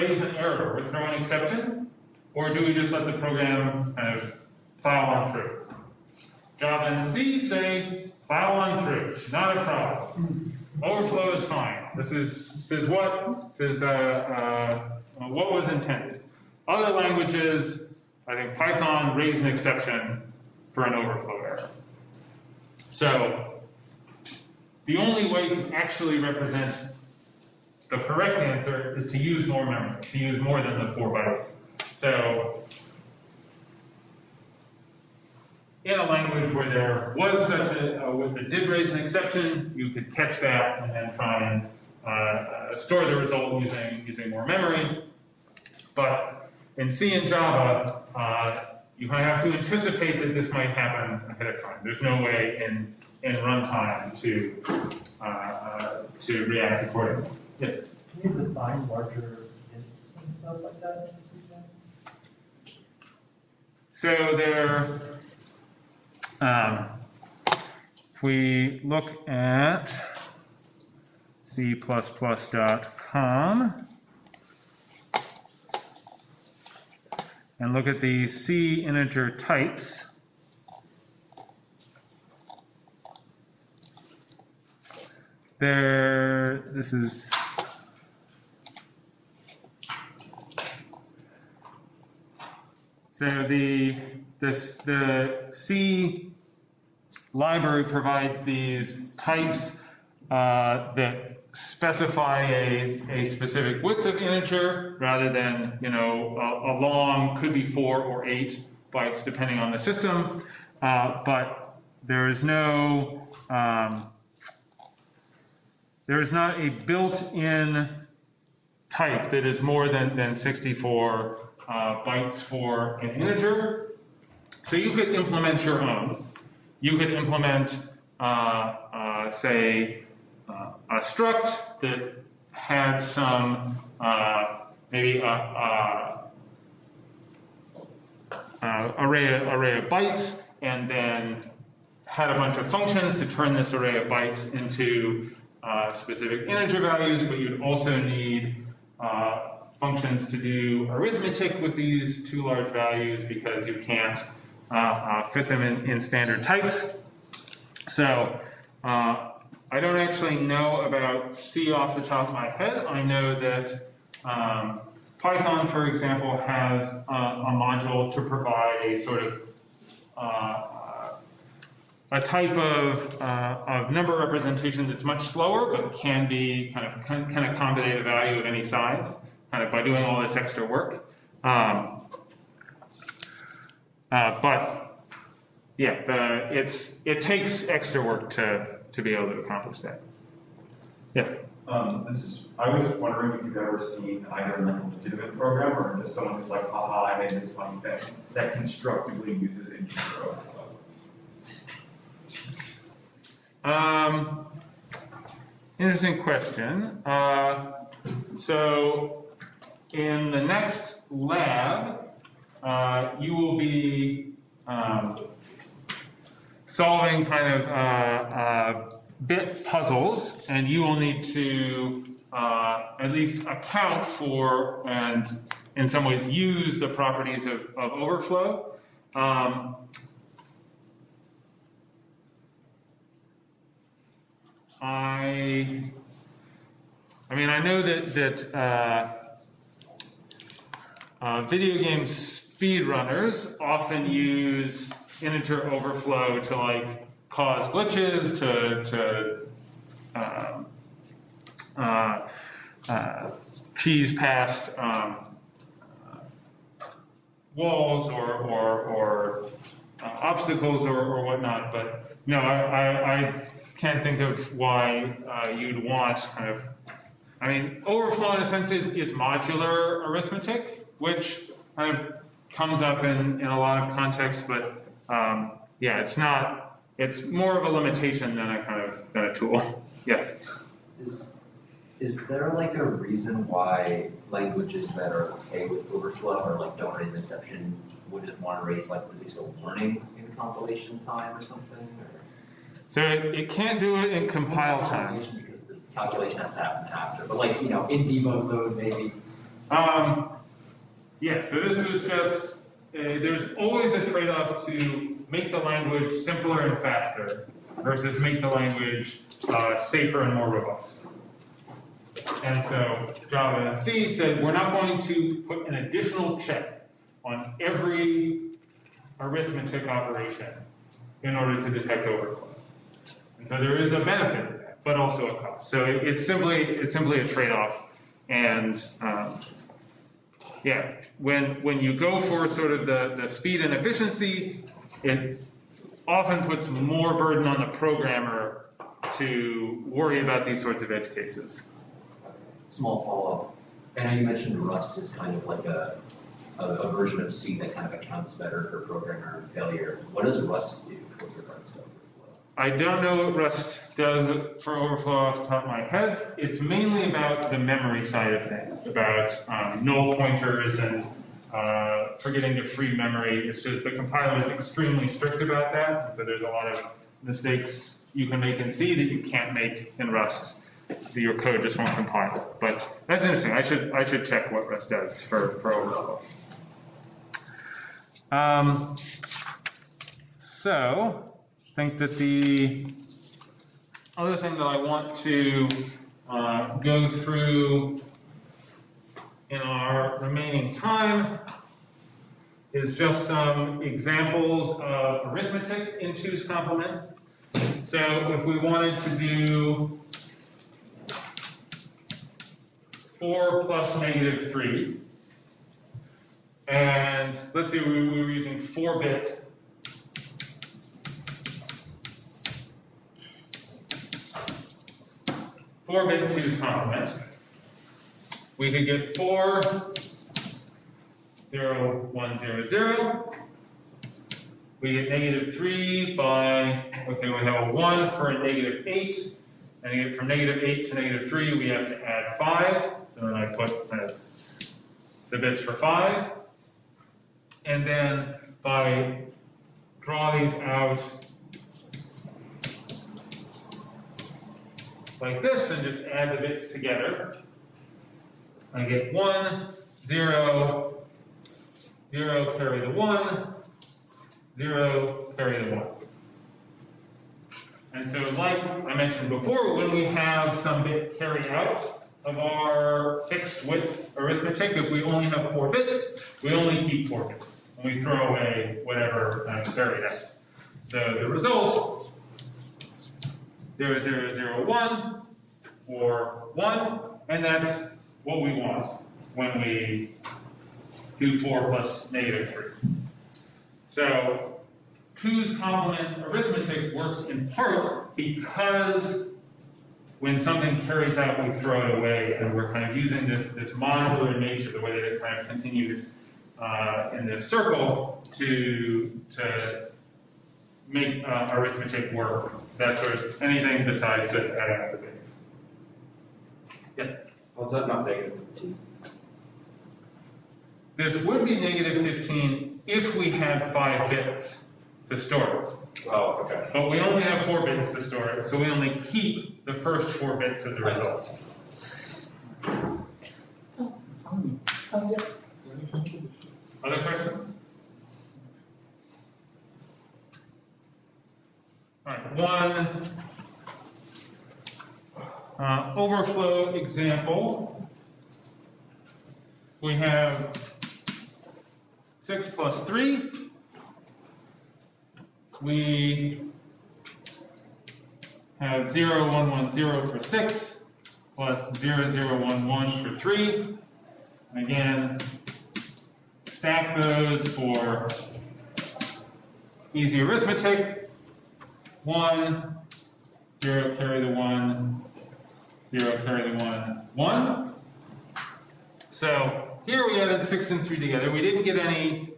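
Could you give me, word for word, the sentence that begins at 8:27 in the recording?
Was oh, that not negative fifteen?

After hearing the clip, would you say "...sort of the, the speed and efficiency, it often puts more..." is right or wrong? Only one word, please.
right.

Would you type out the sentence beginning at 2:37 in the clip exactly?
So uh, I don't actually know about C off the top of my head.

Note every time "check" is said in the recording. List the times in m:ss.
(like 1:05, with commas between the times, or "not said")
5:16, 6:14.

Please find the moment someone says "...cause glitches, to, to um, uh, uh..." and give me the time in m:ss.
4:07.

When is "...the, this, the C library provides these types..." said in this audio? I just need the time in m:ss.
1:33.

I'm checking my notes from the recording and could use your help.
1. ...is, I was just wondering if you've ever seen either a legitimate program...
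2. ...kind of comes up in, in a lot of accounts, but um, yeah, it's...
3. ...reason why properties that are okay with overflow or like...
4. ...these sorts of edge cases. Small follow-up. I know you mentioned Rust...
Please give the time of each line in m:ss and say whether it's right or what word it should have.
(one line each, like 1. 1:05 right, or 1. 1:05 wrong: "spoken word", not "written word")
1. 3:12 right
2. 4:31 wrong: "contexts", not "accounts"
3. 4:42 wrong: "languages", not "properties"
4. 5:40 right.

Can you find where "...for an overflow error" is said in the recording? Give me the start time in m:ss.
0:20.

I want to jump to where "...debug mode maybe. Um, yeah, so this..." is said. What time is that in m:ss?
4:58.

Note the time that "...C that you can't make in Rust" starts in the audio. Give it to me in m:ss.
6:08.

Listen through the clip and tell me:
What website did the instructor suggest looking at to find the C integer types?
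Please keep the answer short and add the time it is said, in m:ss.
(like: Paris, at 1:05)
c++.com, at 1:11.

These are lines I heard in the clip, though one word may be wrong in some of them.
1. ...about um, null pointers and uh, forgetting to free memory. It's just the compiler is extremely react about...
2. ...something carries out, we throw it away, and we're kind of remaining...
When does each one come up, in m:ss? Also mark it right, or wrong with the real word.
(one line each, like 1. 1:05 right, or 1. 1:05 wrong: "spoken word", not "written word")
1. 5:58 wrong: "strict", not "react"
2. 8:10 wrong: "using", not "remaining".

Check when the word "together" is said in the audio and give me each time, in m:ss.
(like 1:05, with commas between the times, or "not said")
7:26, 9:31.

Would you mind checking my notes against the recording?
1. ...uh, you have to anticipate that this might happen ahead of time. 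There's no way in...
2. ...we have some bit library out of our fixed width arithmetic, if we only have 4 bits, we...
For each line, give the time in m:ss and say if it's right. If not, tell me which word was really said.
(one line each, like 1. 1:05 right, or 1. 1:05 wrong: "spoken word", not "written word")
1. 0:48 right
2. 7:39 wrong: "carry", not "library".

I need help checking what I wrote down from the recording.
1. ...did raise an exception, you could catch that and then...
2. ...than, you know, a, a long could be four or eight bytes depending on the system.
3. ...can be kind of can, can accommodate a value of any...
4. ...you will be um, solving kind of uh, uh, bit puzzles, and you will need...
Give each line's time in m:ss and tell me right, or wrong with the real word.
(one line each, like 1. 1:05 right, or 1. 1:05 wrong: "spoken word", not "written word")
1. 0:38 right
2. 1:45 right
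3. 2:55 right
4. 3:33 right.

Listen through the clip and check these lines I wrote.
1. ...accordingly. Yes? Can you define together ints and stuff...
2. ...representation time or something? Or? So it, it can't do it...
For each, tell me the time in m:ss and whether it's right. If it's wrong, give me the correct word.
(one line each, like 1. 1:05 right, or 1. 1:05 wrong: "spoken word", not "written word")
1. 0:56 wrong: "larger", not "together"
2. 4:50 wrong: "compilation", not "representation".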